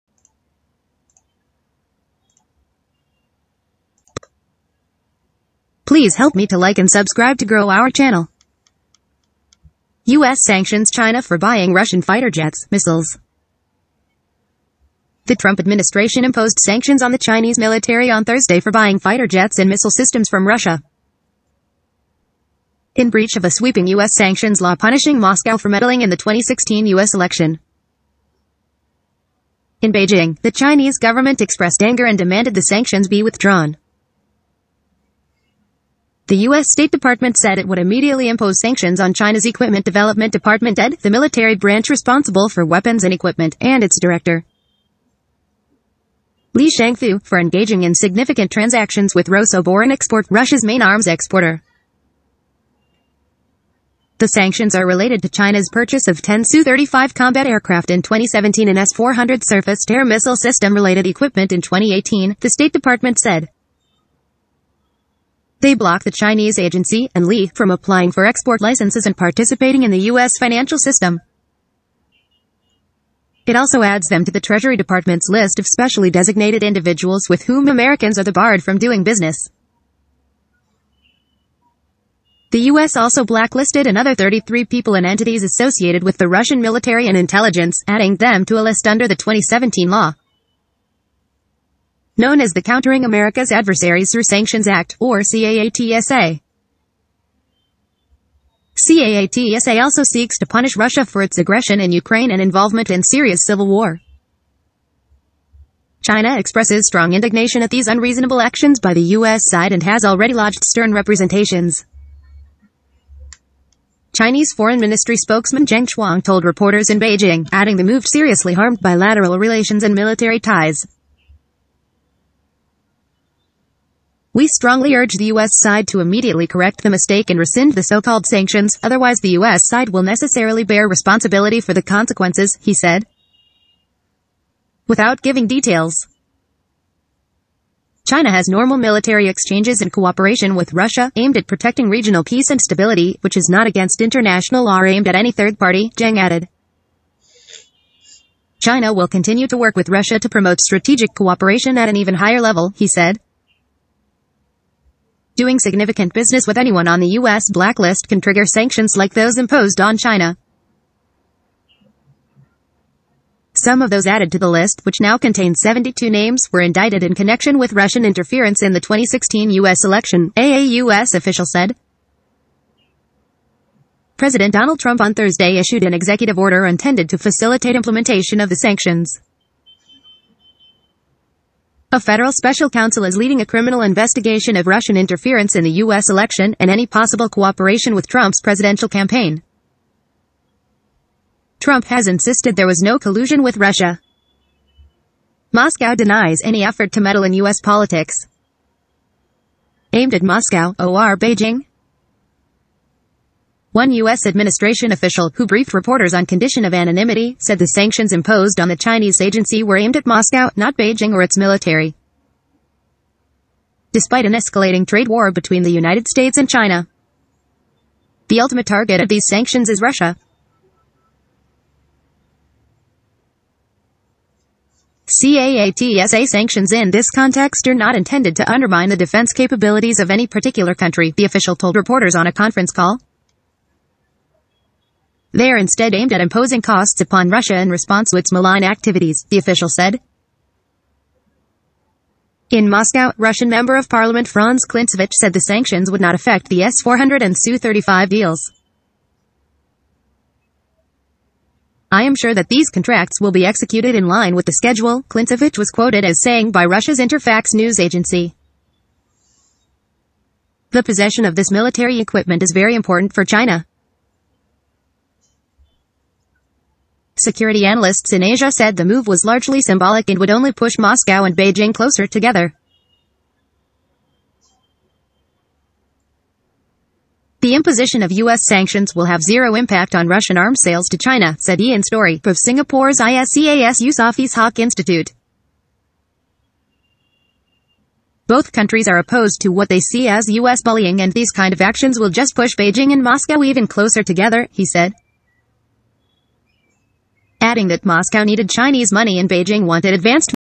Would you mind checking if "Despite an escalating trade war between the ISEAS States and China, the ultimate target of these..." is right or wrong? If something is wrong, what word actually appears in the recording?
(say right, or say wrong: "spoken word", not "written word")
wrong: "United", not "ISEAS".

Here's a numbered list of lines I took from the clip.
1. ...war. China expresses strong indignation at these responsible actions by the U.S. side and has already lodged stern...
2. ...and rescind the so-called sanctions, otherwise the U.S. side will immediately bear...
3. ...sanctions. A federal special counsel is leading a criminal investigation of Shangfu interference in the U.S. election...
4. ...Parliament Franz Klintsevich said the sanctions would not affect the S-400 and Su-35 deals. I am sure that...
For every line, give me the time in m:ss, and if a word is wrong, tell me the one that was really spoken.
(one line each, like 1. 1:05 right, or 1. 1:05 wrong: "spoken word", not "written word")
1. 1:43 wrong: "unreasonable", not "responsible"
2. 2:07 wrong: "necessarily", not "immediately"
3. 2:58 wrong: "Russian", not "Shangfu"
4. 4:03 right.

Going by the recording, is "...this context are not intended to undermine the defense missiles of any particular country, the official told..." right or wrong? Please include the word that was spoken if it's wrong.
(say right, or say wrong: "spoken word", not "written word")
wrong: "capabilities", not "missiles".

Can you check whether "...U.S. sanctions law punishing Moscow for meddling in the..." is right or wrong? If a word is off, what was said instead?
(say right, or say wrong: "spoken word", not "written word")
right.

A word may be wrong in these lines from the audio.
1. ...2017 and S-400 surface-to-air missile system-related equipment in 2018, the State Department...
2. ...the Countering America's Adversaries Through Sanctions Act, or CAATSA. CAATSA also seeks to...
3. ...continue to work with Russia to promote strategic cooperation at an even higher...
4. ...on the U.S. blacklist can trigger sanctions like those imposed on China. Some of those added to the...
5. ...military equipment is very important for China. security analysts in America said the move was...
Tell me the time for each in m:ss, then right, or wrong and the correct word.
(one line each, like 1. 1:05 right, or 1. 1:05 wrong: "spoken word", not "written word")
1. 0:58 right
2. 1:32 right
3. 2:29 right
4. 2:36 right
5. 4:21 wrong: "Asia", not "America".